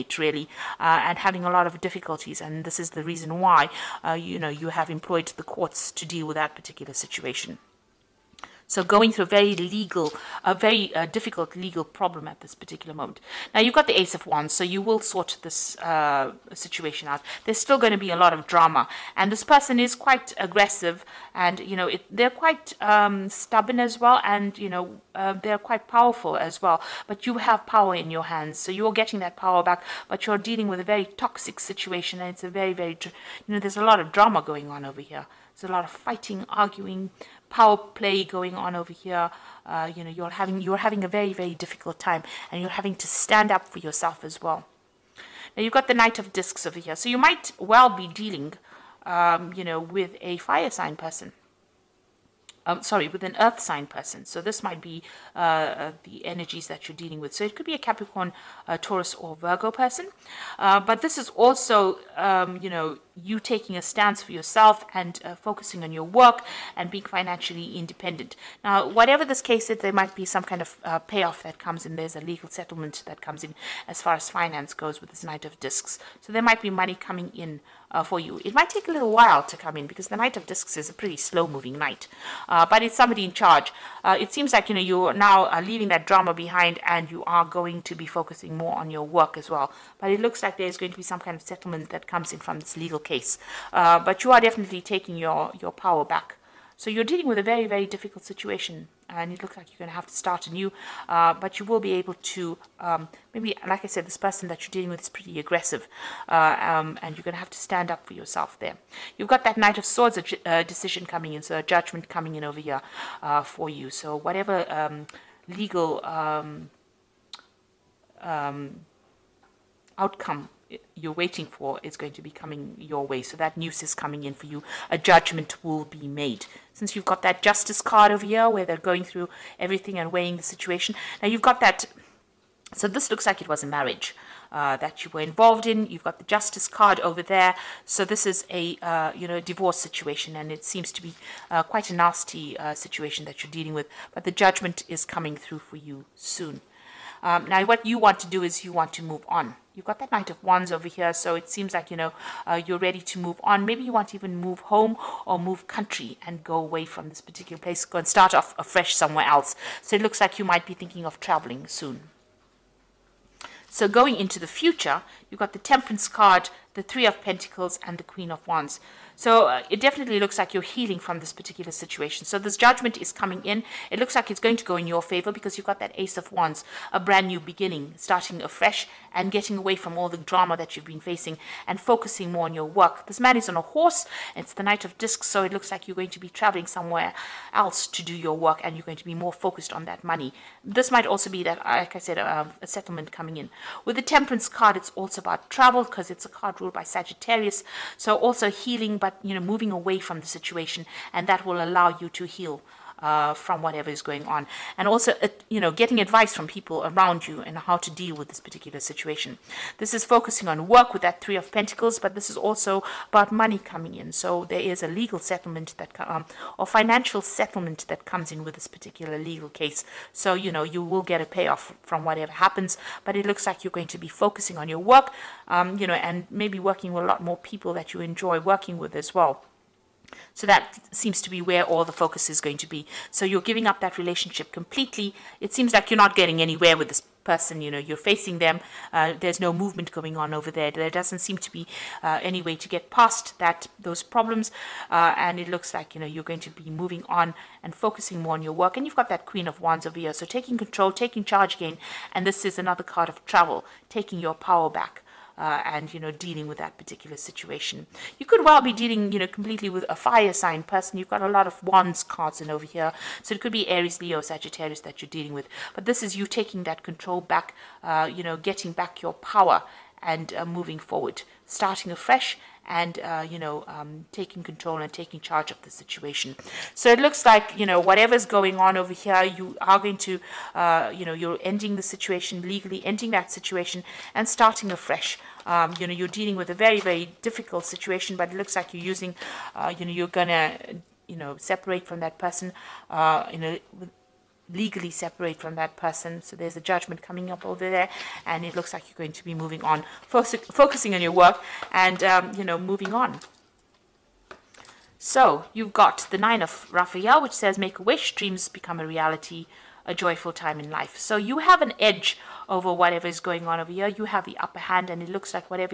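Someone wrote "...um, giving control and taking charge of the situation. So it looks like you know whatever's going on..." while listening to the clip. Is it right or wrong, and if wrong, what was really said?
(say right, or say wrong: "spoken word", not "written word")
wrong: "taking", not "giving".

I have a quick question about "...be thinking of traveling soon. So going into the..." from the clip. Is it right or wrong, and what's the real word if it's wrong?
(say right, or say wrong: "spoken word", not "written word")
right.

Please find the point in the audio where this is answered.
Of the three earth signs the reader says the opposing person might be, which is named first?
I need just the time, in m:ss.
0:57.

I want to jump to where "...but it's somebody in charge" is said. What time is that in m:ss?
1:22.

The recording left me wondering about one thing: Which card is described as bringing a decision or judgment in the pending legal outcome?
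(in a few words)
Knight of Swords.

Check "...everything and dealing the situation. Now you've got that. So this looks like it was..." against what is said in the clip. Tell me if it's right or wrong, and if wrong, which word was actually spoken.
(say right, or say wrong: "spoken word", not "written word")
wrong: "weighing", not "dealing".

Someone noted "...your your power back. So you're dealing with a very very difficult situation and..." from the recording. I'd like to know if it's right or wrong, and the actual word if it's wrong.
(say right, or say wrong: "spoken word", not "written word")
right.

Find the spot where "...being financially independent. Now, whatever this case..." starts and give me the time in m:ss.
1:06.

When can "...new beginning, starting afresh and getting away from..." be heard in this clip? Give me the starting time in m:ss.
2:57.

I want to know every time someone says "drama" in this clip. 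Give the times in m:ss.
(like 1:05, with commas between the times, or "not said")
0:18, 0:34, 1:26, 3:00.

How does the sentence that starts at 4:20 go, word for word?
You've got a lot of wands cards in over here, so it could be Aries, Leo, Sagittarius that you're dealing with.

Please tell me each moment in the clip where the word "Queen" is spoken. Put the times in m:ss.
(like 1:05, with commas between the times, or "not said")
2:48, 4:09.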